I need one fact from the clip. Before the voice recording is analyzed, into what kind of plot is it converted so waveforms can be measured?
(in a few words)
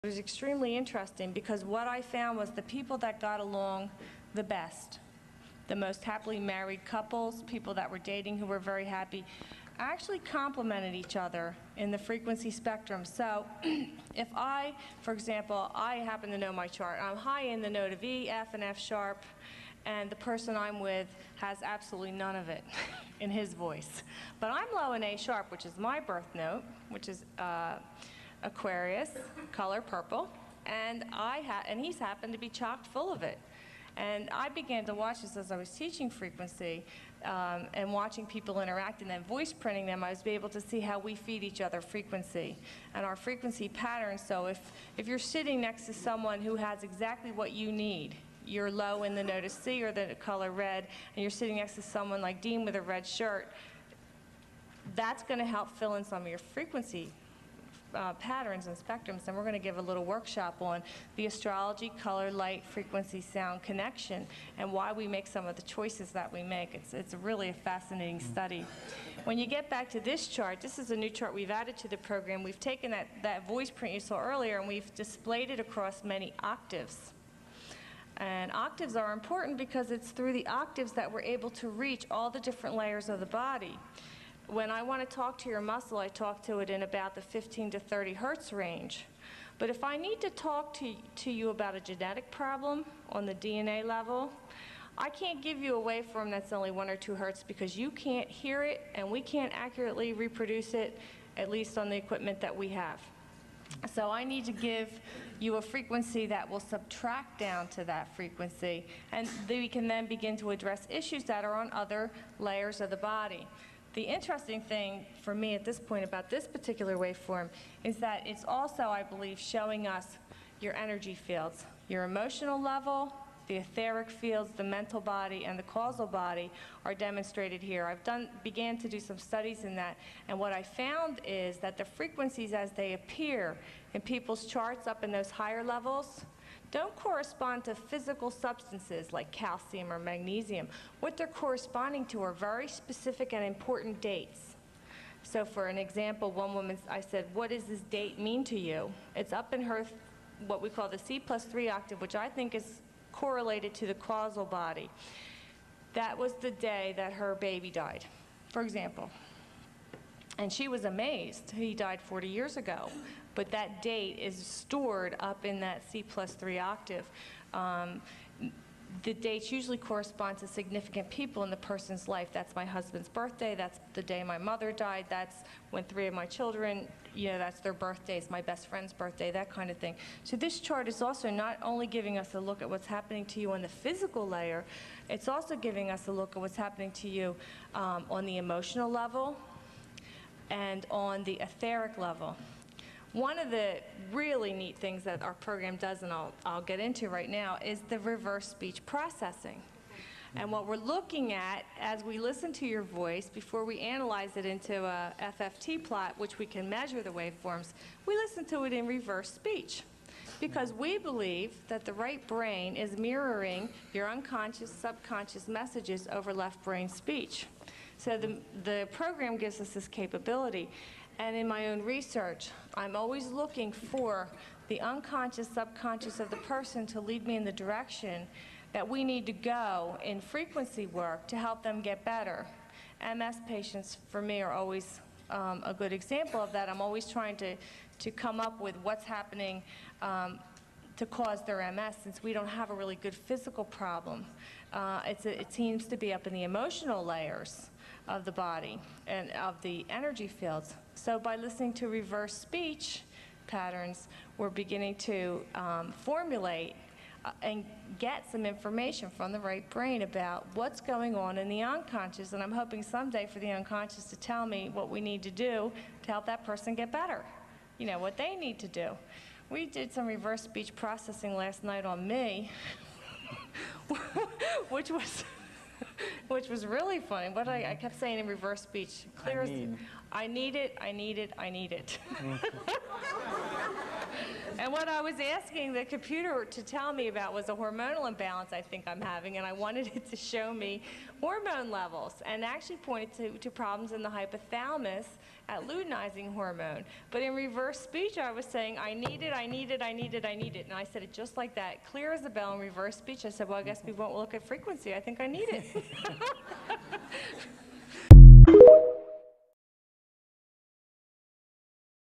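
FFT plot.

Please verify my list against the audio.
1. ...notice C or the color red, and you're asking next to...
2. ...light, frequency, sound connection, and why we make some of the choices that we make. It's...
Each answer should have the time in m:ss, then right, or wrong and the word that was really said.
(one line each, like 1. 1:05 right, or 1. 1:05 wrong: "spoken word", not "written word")
1. 0:49 wrong: "sitting", not "asking"
2. 1:02 right.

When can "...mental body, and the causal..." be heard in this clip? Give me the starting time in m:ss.
2:04.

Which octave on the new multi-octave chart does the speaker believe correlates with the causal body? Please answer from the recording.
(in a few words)
C plus 3.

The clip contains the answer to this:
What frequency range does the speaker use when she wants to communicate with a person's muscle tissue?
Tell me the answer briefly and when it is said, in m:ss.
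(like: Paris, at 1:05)
15 to 30 hertz, at 1:27.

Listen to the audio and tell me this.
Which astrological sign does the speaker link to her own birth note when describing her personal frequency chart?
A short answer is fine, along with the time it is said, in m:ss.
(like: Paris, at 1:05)
Aquarius, at 0:28.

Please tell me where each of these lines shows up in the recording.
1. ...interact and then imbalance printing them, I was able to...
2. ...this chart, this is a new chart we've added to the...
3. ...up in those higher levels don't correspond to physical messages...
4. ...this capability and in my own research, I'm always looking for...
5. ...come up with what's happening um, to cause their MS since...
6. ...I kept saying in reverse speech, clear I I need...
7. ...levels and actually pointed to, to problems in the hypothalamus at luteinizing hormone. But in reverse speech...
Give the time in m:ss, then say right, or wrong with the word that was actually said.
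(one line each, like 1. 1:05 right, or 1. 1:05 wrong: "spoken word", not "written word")
1. 0:38 wrong: "voice", not "imbalance"
2. 1:09 right
3. 2:14 wrong: "substances", not "messages"
4. 3:39 right
5. 3:58 right
6. 4:37 right
7. 4:51 right.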